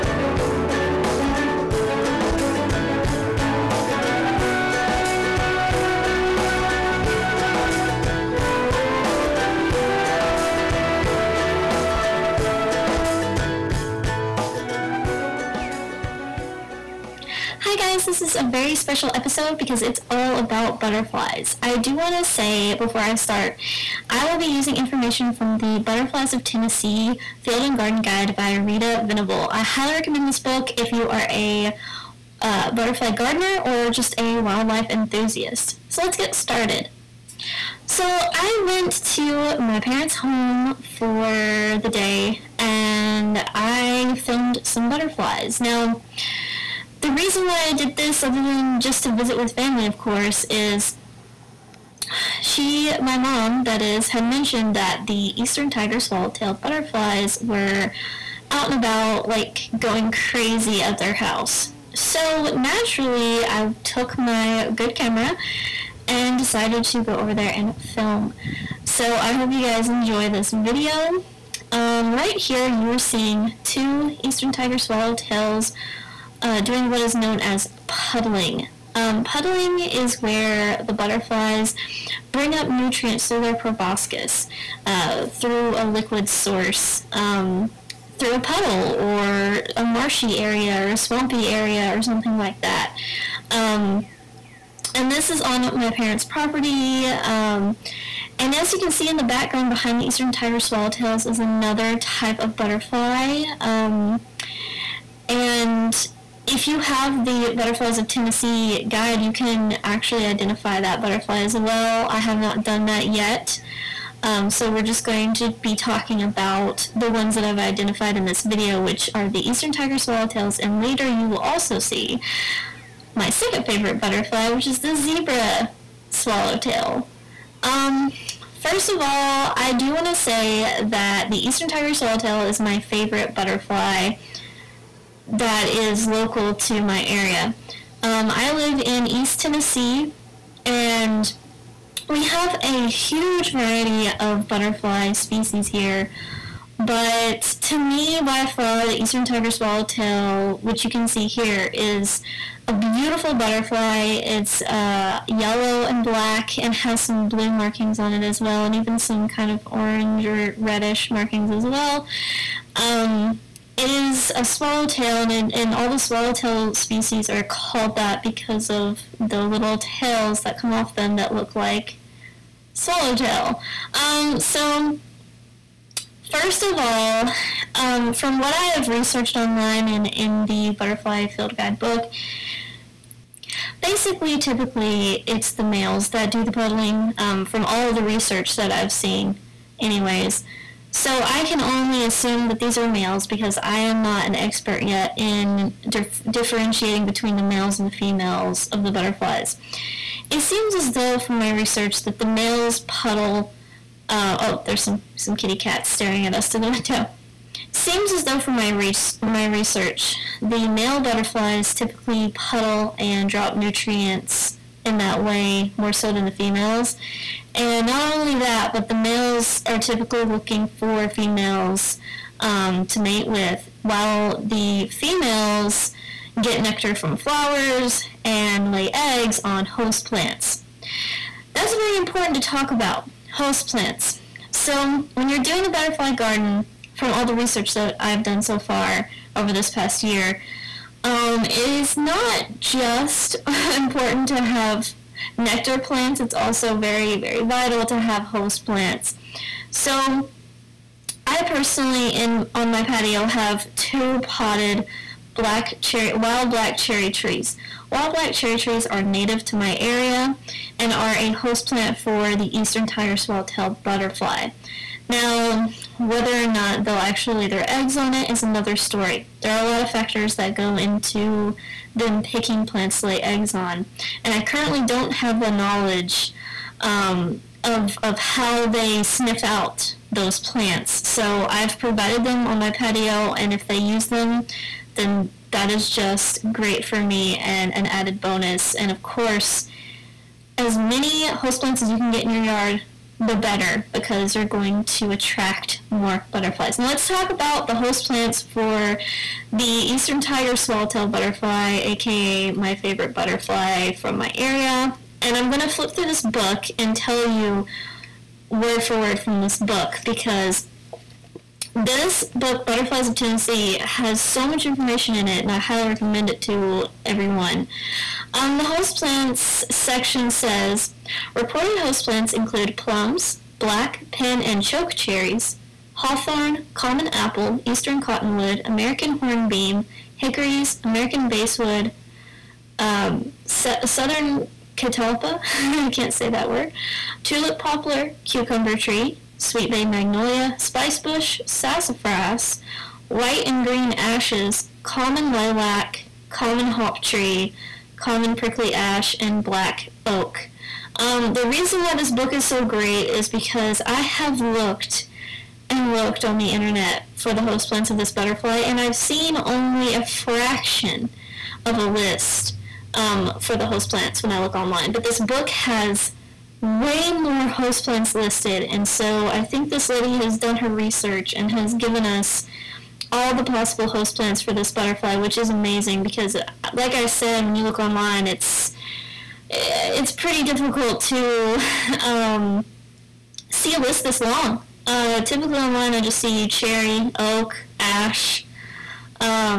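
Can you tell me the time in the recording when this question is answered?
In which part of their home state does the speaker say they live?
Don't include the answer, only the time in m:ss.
2:19.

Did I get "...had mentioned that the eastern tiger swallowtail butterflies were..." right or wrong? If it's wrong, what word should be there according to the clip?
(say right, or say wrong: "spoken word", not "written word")
right.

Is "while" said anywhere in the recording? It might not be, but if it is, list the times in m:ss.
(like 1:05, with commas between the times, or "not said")
3:43.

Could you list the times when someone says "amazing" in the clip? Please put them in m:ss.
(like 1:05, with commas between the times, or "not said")
6:15.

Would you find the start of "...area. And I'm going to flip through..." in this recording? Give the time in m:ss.
5:04.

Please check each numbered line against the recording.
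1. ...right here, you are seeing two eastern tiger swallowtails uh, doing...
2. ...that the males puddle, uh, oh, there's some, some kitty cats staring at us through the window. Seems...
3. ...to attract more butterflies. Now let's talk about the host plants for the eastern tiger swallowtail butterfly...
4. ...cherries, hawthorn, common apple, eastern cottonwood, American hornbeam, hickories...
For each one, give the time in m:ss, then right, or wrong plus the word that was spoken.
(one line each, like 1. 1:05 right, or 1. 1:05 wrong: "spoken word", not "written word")
1. 1:12 right
2. 3:22 right
3. 4:54 right
4. 5:24 right.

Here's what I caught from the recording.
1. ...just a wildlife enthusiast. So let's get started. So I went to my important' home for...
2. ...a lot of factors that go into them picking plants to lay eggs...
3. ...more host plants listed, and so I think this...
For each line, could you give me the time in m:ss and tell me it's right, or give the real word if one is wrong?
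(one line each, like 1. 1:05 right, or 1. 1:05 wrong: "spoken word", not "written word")
1. 0:33 wrong: "parents", not "important"
2. 4:29 right
3. 6:07 right.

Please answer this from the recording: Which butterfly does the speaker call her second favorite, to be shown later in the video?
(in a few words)
zebra swallowtail.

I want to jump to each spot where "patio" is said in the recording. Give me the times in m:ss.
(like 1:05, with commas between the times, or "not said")
4:12, 4:42.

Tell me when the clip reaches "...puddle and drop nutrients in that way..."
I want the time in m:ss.
3:32.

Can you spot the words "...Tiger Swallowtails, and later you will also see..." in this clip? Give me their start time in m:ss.
1:59.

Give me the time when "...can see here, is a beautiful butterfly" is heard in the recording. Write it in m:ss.
2:30.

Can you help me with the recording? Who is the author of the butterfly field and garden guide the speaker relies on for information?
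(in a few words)
Rita Venable.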